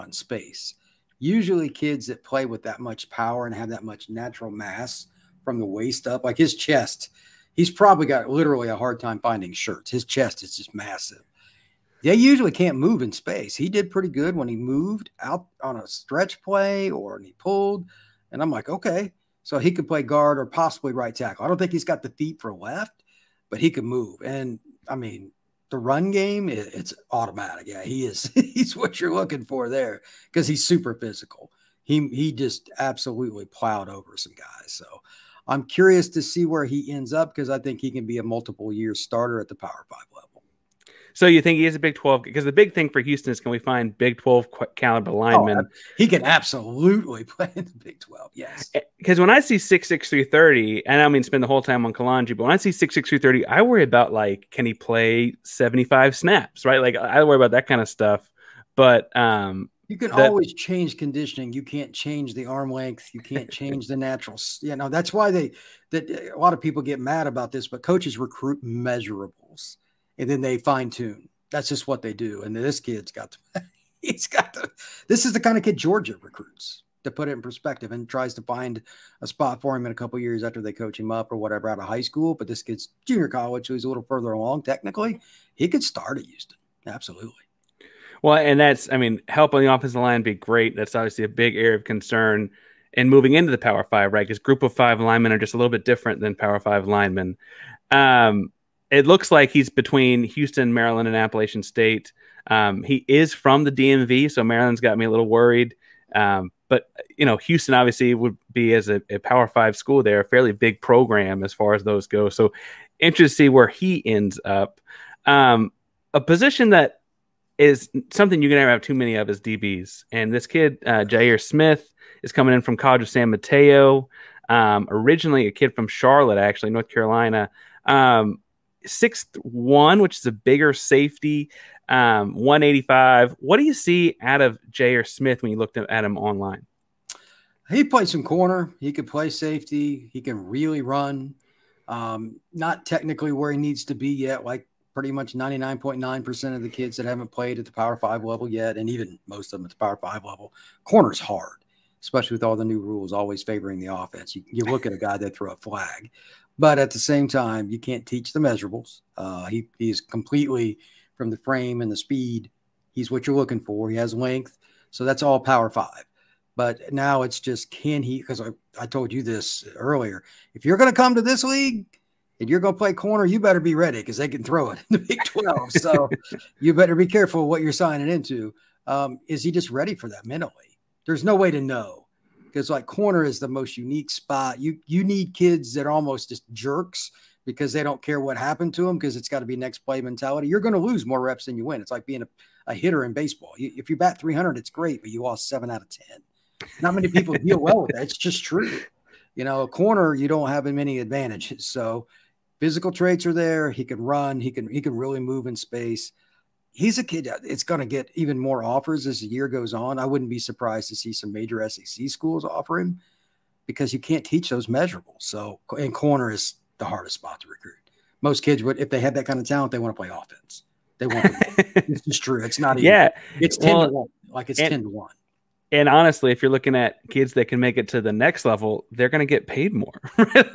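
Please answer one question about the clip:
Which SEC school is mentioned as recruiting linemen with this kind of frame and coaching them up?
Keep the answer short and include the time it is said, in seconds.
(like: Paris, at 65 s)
Georgia, at 75 s.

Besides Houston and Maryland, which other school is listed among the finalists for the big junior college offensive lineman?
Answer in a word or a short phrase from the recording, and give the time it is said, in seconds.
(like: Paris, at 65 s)
Appalachian State, at 101 s.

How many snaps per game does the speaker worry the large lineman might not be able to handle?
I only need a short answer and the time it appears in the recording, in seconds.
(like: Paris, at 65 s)
75, at 55 s.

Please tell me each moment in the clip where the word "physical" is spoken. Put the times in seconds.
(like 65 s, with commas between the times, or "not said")
30 s, 202 s.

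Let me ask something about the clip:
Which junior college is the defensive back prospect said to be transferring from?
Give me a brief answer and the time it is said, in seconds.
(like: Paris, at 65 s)
College of San Mateo, at 122 s.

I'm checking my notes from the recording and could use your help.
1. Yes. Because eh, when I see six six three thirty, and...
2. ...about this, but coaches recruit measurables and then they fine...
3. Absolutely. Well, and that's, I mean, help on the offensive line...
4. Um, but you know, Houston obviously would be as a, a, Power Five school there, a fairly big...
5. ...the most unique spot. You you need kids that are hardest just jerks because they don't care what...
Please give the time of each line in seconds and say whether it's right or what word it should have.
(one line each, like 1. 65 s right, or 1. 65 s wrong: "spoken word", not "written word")
1. 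48 s right
2. 67 s right
3. 86 s right
4. 106 s right
5. 183 s wrong: "almost", not "hardest".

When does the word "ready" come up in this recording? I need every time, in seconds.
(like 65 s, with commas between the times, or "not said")
173 s, 179 s.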